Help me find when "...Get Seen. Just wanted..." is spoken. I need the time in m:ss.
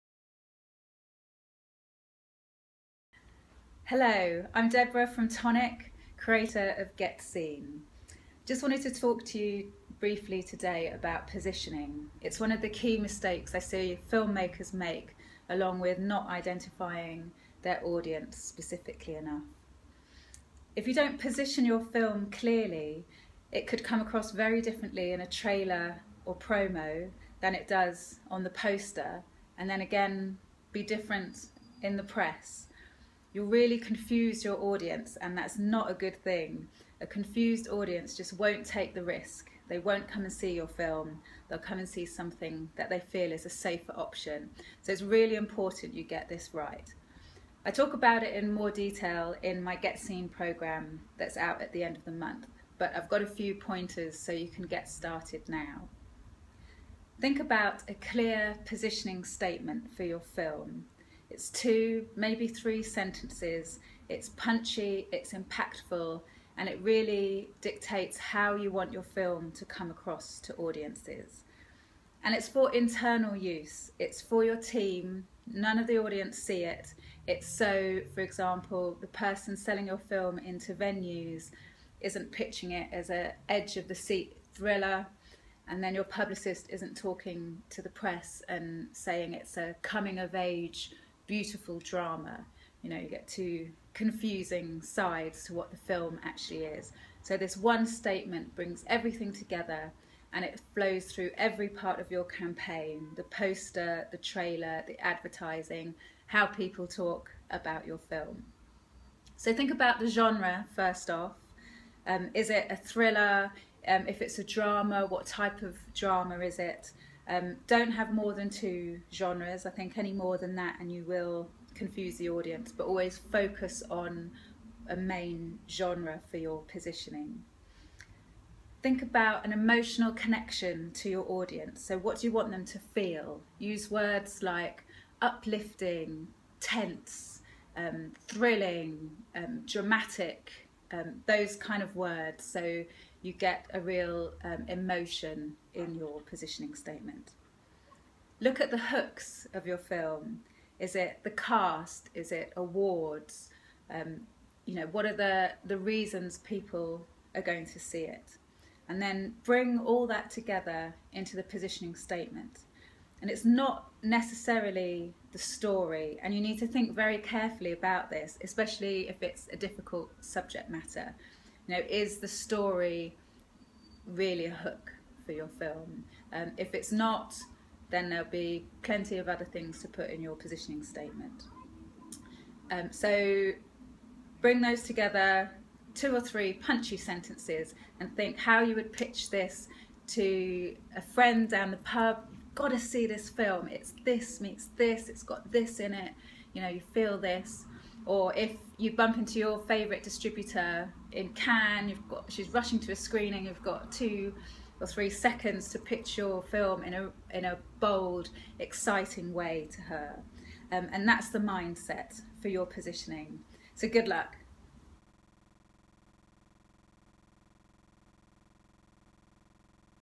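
0:06.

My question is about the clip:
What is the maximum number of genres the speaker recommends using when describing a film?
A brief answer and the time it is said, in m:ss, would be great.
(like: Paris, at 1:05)
2, at 1:57.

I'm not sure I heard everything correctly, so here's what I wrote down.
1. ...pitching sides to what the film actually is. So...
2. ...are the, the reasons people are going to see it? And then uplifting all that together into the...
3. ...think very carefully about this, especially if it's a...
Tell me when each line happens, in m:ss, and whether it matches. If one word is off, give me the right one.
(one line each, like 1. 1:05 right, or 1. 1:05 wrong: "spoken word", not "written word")
1. 1:33 wrong: "confusing", not "pitching"
2. 2:35 wrong: "bring", not "uplifting"
3. 2:46 right.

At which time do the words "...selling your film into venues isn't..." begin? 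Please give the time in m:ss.
1:19.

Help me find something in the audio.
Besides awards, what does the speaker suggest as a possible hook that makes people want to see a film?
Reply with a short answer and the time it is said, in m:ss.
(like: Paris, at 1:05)
The cast, at 2:30.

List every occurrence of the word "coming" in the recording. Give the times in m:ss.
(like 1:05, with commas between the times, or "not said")
1:29.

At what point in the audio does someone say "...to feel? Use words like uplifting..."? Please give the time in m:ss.
2:12.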